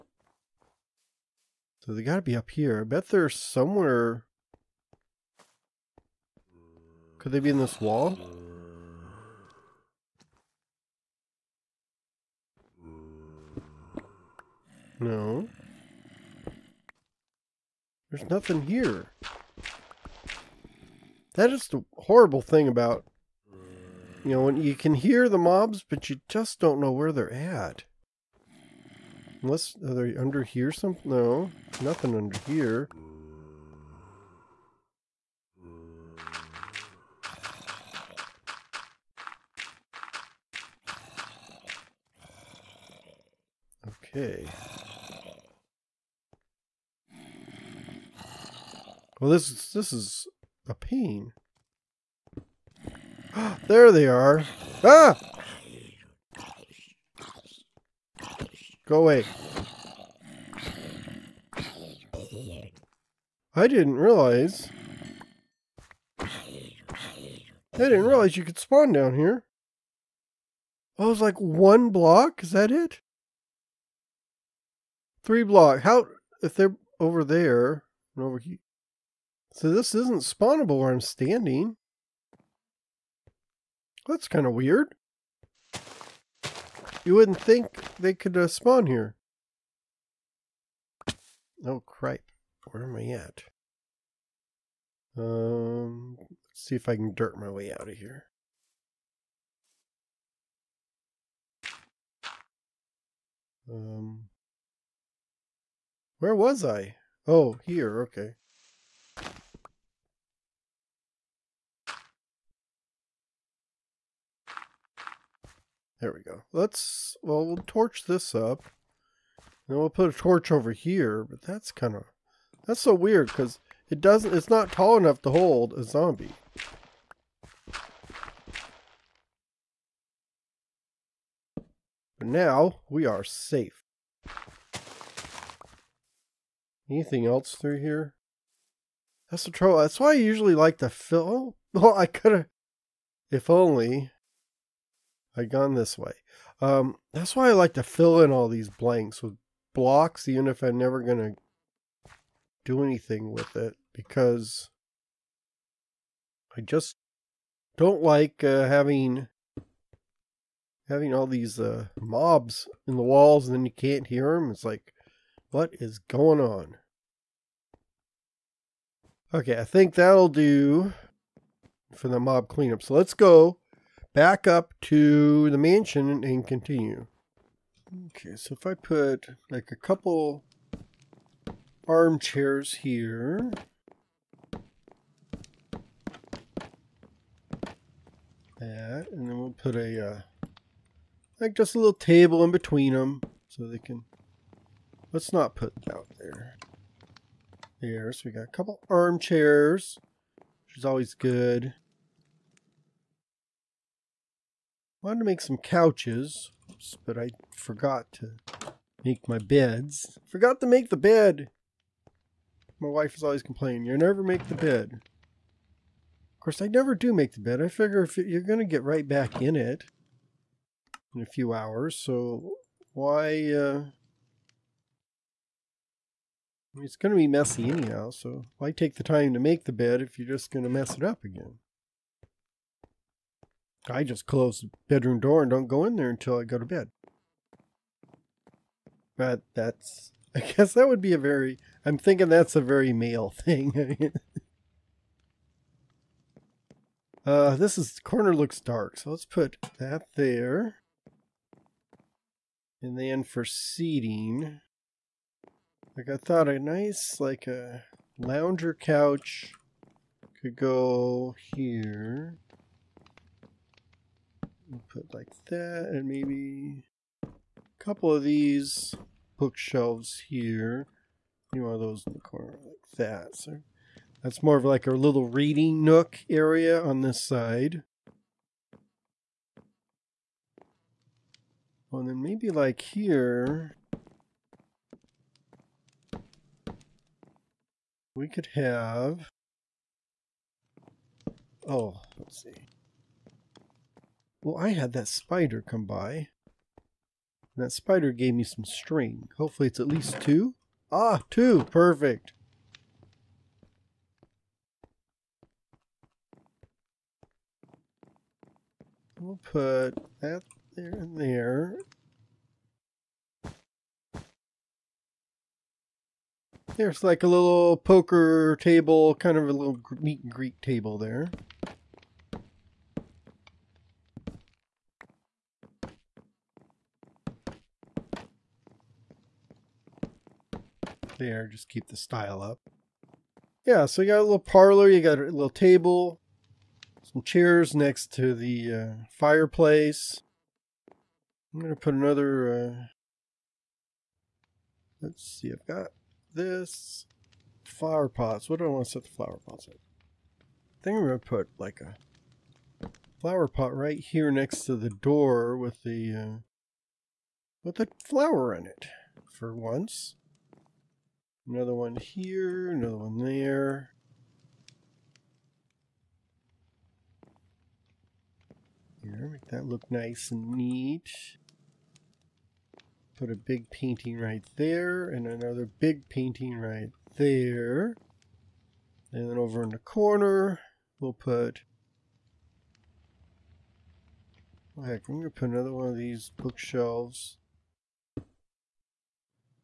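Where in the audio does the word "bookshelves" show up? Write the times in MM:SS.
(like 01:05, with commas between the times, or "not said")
04:29, 06:26.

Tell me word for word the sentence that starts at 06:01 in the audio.
Another one here, another one there.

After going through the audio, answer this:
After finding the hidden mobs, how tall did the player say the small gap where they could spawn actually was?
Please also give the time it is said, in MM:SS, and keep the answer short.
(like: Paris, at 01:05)
3 blocks, at 01:15.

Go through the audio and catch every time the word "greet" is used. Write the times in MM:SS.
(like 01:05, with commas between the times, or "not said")
05:20.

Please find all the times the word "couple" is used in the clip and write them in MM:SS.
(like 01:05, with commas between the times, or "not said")
02:59, 03:18, 04:27.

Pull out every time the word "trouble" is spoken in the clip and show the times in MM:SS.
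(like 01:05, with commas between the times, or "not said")
02:19.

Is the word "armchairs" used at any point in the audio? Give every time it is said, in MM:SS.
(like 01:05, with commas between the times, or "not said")
03:01, 03:18.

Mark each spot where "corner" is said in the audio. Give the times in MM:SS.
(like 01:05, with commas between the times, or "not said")
04:07, 04:32, 06:19.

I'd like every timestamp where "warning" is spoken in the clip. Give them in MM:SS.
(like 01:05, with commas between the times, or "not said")
not said.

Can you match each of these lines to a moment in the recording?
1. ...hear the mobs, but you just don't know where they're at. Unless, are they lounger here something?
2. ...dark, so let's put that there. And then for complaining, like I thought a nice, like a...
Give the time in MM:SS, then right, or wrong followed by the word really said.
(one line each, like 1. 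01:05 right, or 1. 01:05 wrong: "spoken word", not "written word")
1. 00:24 wrong: "under", not "lounger"
2. 04:08 wrong: "seating", not "complaining".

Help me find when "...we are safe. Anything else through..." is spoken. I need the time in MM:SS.
02:12.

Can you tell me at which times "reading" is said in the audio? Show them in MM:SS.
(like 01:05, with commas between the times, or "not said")
04:35.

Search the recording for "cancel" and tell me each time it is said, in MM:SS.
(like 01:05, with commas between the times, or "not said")
not said.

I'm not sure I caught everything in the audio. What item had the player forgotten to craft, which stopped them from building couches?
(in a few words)
beds.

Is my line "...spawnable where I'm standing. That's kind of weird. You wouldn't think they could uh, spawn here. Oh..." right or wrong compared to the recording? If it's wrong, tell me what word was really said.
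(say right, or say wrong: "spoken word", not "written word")
right.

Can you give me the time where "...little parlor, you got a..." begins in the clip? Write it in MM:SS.
05:34.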